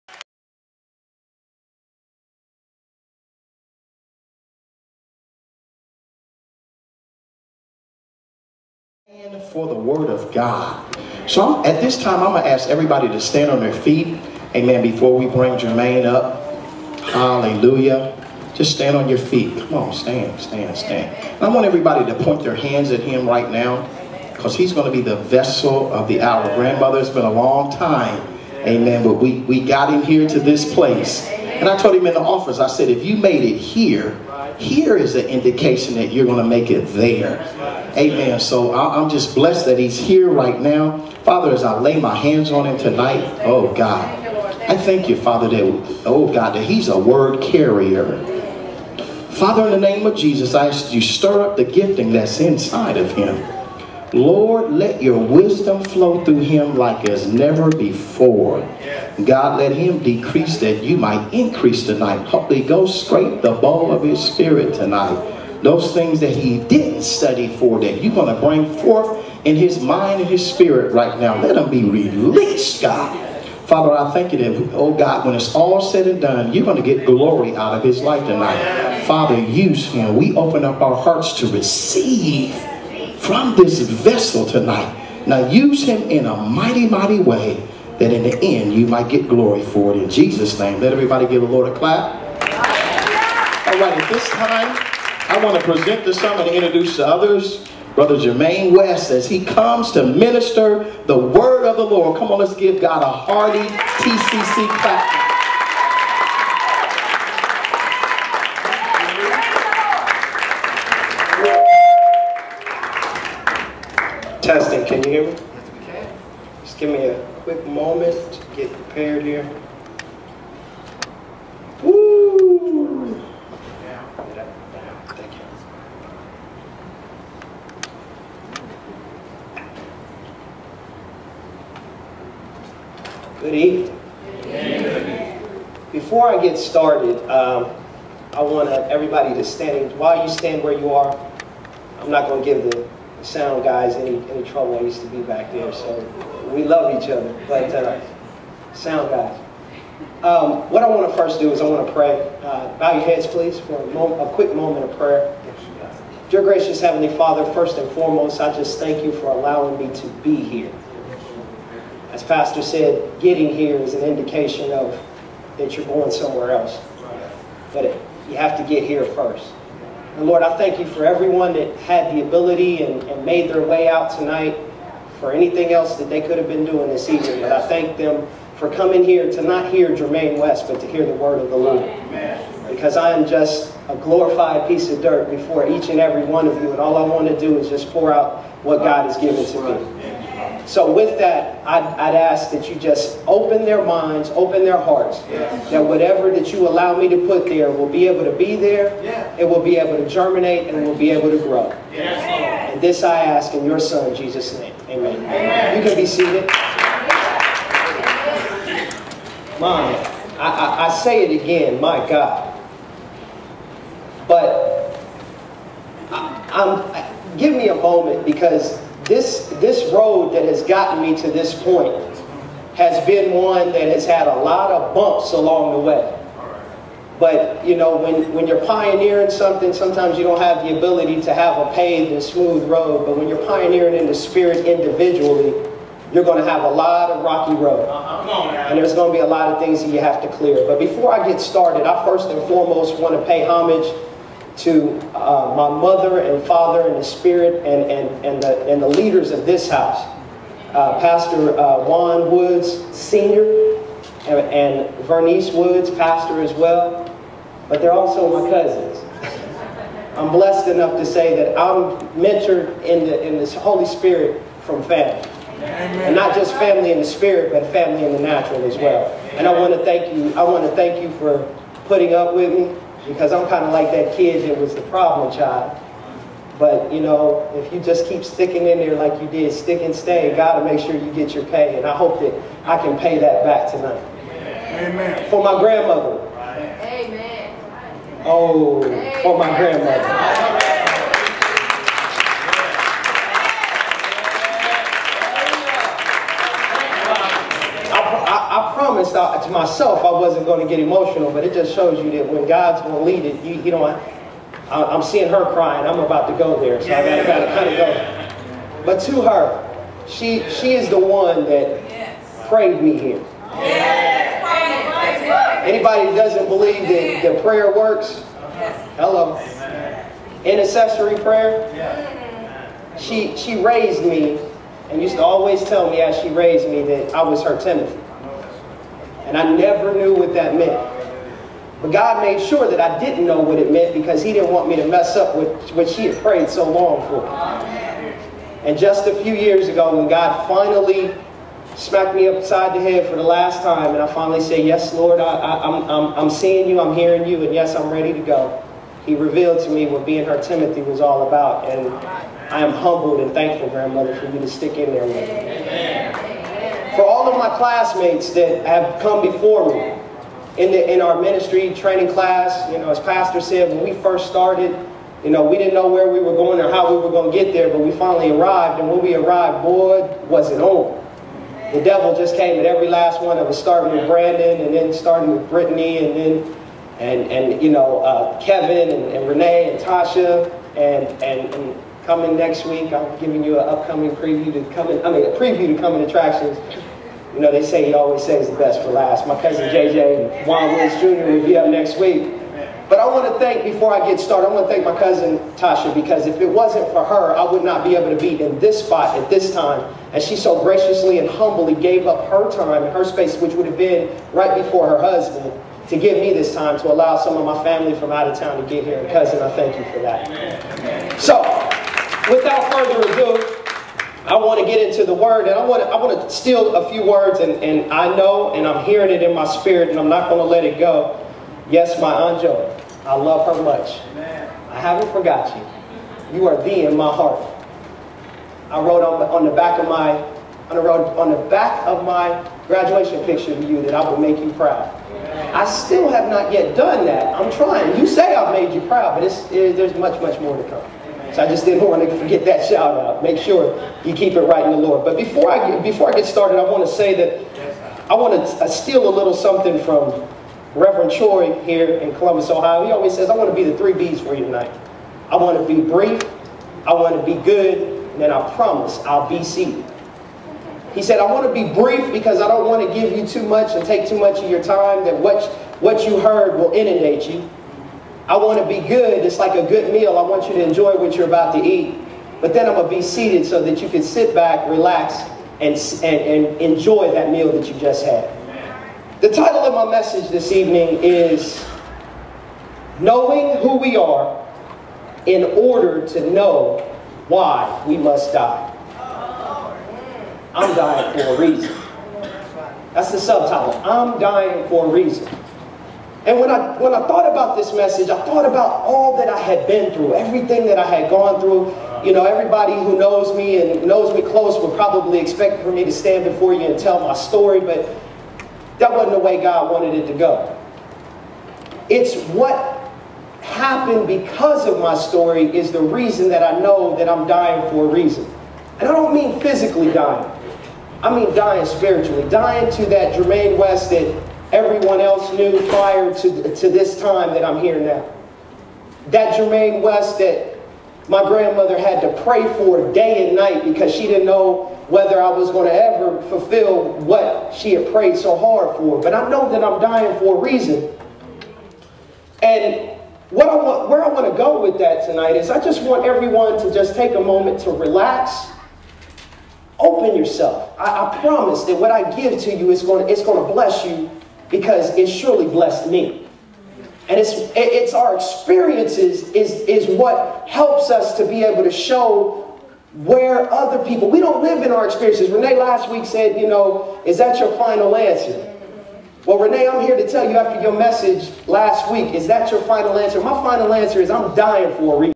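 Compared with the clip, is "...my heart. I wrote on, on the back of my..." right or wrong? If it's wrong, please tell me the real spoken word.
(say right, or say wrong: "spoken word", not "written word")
right.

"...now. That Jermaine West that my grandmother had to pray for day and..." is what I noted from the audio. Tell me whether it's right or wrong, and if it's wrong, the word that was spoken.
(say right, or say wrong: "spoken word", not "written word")
right.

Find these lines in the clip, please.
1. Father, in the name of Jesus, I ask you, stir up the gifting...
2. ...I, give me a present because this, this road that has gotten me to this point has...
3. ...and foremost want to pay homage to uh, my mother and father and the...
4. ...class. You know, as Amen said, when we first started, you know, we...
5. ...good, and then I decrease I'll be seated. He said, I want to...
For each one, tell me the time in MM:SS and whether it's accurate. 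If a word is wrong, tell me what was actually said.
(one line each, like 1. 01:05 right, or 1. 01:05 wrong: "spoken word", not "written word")
1. 00:49 right
2. 03:36 wrong: "moment", not "present"
3. 04:02 right
4. 06:02 wrong: "Pastor", not "Amen"
5. 07:37 wrong: "promise", not "decrease".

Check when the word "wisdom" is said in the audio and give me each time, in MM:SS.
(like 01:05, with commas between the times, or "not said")
00:55.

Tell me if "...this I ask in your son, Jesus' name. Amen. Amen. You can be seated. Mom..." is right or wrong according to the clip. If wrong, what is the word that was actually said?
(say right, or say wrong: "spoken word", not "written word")
right.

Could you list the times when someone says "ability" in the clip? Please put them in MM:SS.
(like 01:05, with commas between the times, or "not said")
02:52, 03:50.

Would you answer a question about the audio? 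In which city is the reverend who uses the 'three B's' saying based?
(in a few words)
Columbus, Ohio.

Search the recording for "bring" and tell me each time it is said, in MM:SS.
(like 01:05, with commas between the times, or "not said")
00:15, 01:08.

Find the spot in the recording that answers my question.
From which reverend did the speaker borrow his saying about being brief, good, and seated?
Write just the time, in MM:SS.
07:30.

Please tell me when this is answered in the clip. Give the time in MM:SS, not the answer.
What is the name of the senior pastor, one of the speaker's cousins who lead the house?
04:11.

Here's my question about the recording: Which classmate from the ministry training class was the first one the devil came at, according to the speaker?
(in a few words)
Brandon.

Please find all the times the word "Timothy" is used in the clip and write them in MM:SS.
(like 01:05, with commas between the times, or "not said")
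05:27, 05:50.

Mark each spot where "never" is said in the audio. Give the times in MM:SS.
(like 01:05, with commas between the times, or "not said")
00:57, 05:29.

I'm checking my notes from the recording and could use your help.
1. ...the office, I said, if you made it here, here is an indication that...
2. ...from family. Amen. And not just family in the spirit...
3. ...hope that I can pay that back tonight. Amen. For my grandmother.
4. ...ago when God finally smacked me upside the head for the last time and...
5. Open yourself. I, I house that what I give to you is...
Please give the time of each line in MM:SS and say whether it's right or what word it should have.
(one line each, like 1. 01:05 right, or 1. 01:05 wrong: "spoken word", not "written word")
1. 00:32 right
2. 04:24 right
3. 04:41 right
4. 05:39 right
5. 09:09 wrong: "promise", not "house".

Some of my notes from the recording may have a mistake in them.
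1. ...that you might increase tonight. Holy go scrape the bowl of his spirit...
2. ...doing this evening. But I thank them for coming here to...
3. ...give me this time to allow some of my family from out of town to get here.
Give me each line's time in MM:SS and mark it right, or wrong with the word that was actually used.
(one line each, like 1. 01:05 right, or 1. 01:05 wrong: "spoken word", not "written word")
1. 01:00 right
2. 02:56 right
3. 06:45 right.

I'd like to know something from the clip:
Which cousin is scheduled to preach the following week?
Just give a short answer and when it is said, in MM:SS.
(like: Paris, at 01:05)
JJ Juan Woods Jr., at 06:29.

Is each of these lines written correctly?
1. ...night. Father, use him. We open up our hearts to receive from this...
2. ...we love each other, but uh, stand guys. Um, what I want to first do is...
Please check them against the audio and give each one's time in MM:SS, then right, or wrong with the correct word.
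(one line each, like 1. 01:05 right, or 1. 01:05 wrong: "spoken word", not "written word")
1. 01:18 wrong: "tonight", not "night"
2. 02:26 wrong: "sound", not "stand".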